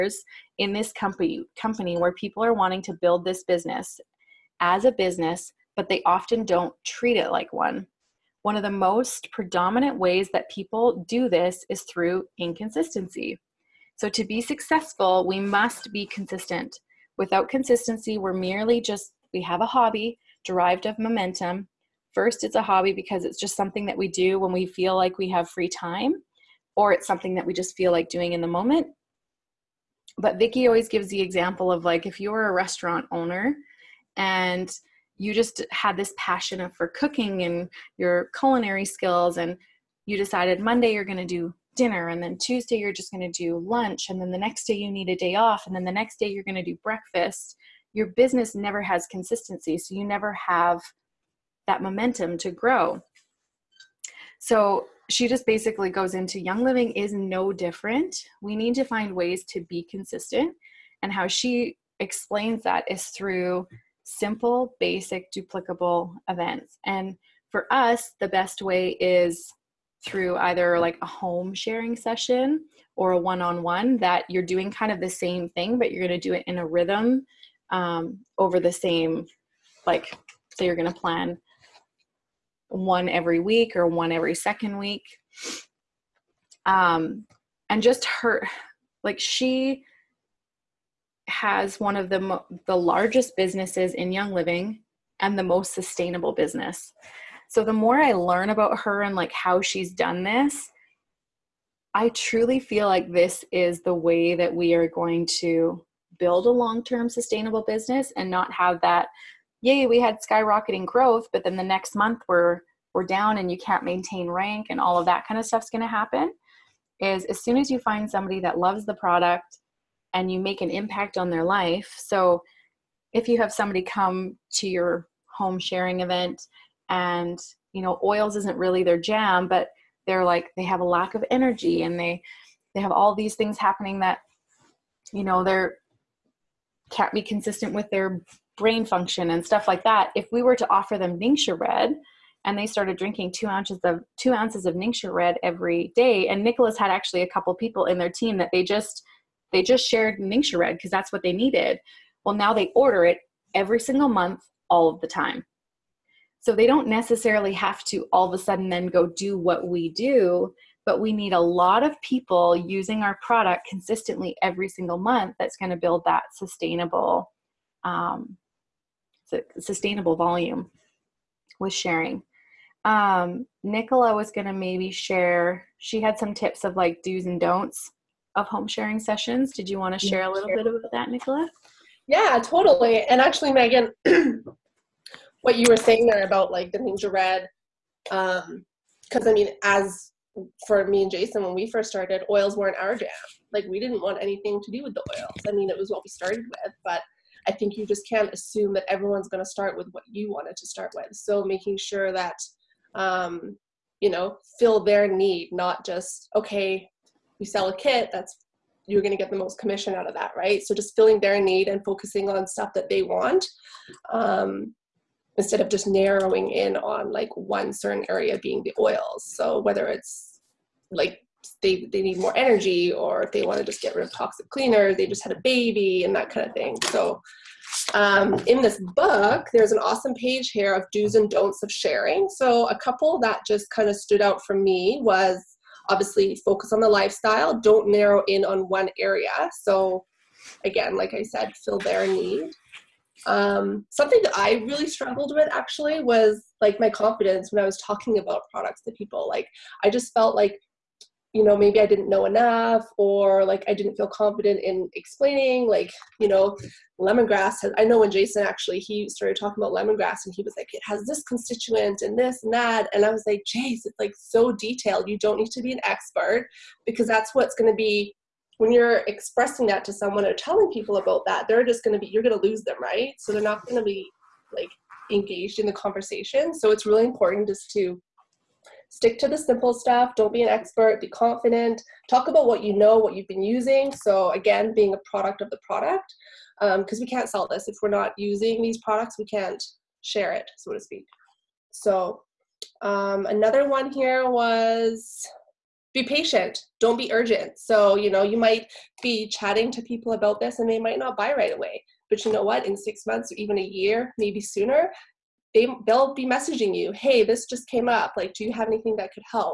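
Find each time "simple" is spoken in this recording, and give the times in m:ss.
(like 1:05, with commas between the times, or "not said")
1:04, 4:39.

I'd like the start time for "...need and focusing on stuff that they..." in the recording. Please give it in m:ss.
3:31.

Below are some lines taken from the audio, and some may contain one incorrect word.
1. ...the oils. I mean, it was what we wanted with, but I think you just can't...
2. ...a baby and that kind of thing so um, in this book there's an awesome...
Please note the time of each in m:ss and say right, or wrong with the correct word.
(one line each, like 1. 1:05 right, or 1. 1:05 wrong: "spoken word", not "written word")
1. 3:14 wrong: "started", not "wanted"
2. 3:45 right.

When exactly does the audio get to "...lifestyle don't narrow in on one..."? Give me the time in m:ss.
3:56.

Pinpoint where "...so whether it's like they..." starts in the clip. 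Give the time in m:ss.
3:39.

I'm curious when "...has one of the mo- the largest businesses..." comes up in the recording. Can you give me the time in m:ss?
1:31.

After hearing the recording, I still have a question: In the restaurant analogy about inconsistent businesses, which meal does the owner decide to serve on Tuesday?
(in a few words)
lunch.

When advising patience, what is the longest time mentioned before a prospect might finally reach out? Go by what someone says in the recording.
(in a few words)
a year.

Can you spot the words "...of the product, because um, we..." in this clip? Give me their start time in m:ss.
4:45.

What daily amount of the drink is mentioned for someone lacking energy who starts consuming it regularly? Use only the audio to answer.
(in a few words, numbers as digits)
2 ounces.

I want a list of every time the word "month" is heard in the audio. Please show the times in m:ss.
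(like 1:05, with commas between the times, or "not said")
1:51, 2:34, 2:44, 5:03.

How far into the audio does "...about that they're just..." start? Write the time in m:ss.
4:30.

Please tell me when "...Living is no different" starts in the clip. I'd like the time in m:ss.
0:56.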